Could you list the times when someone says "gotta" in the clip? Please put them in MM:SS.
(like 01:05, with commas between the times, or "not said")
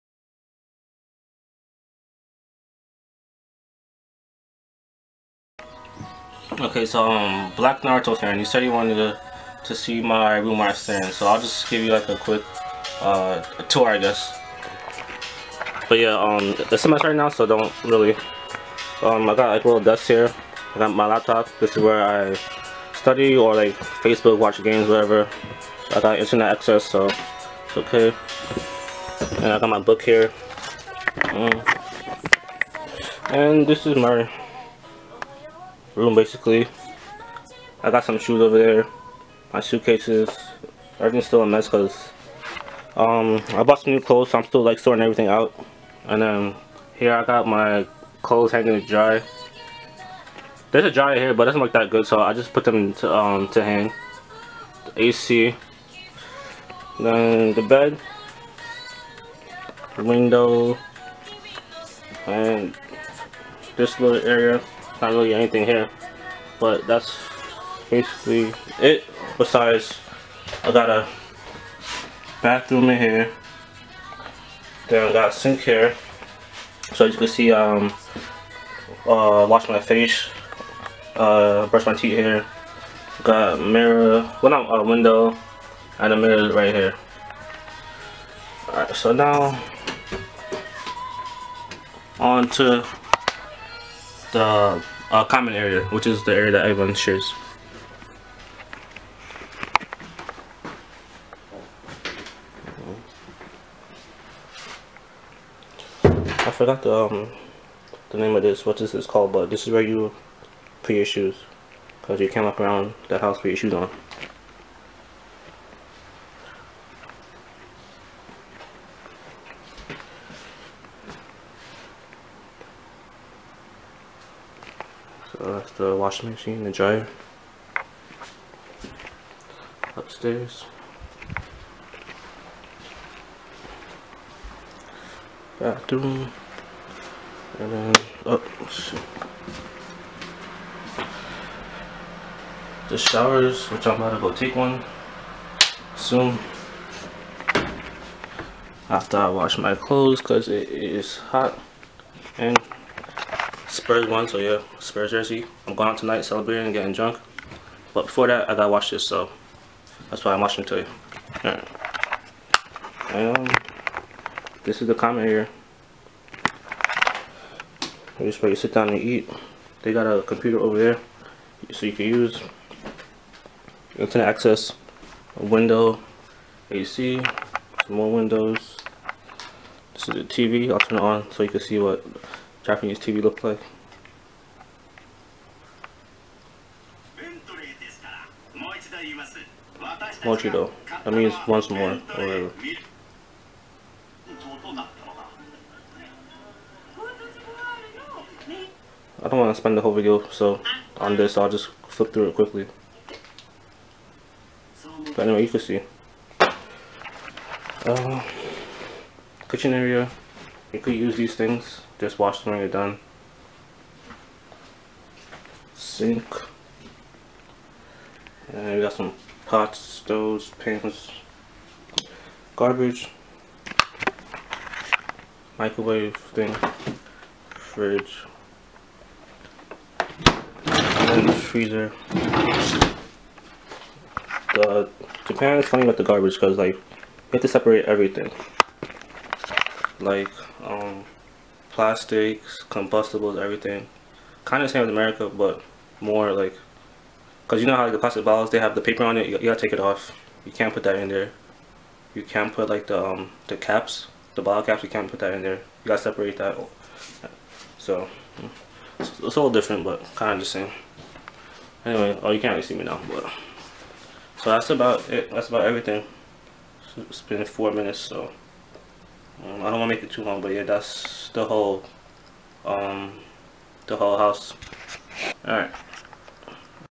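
02:38, 04:09, 04:15.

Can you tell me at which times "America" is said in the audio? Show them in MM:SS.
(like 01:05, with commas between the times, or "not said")
04:04.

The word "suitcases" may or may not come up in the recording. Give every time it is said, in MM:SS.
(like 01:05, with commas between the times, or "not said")
00:39.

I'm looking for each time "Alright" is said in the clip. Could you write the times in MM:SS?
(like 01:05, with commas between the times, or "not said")
01:28, 02:41.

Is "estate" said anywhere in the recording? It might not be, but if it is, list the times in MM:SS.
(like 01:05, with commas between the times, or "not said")
not said.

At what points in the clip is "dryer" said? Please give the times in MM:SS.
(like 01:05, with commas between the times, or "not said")
00:50, 02:06.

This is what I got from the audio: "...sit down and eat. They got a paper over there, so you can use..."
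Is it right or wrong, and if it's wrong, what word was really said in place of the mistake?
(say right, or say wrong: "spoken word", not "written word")
wrong: "computer", not "paper".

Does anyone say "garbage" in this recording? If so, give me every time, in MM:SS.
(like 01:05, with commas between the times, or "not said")
03:42, 03:56.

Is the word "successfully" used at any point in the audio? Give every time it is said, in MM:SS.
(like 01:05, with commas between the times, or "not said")
not said.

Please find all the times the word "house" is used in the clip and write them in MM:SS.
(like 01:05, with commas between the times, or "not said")
01:53, 04:34.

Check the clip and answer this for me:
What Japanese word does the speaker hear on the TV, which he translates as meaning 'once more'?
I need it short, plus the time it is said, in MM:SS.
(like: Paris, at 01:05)
Mochido, at 03:10.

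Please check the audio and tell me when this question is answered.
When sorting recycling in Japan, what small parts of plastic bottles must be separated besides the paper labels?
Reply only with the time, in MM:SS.
04:14.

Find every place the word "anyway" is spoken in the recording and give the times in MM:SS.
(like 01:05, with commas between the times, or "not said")
03:25, 04:21.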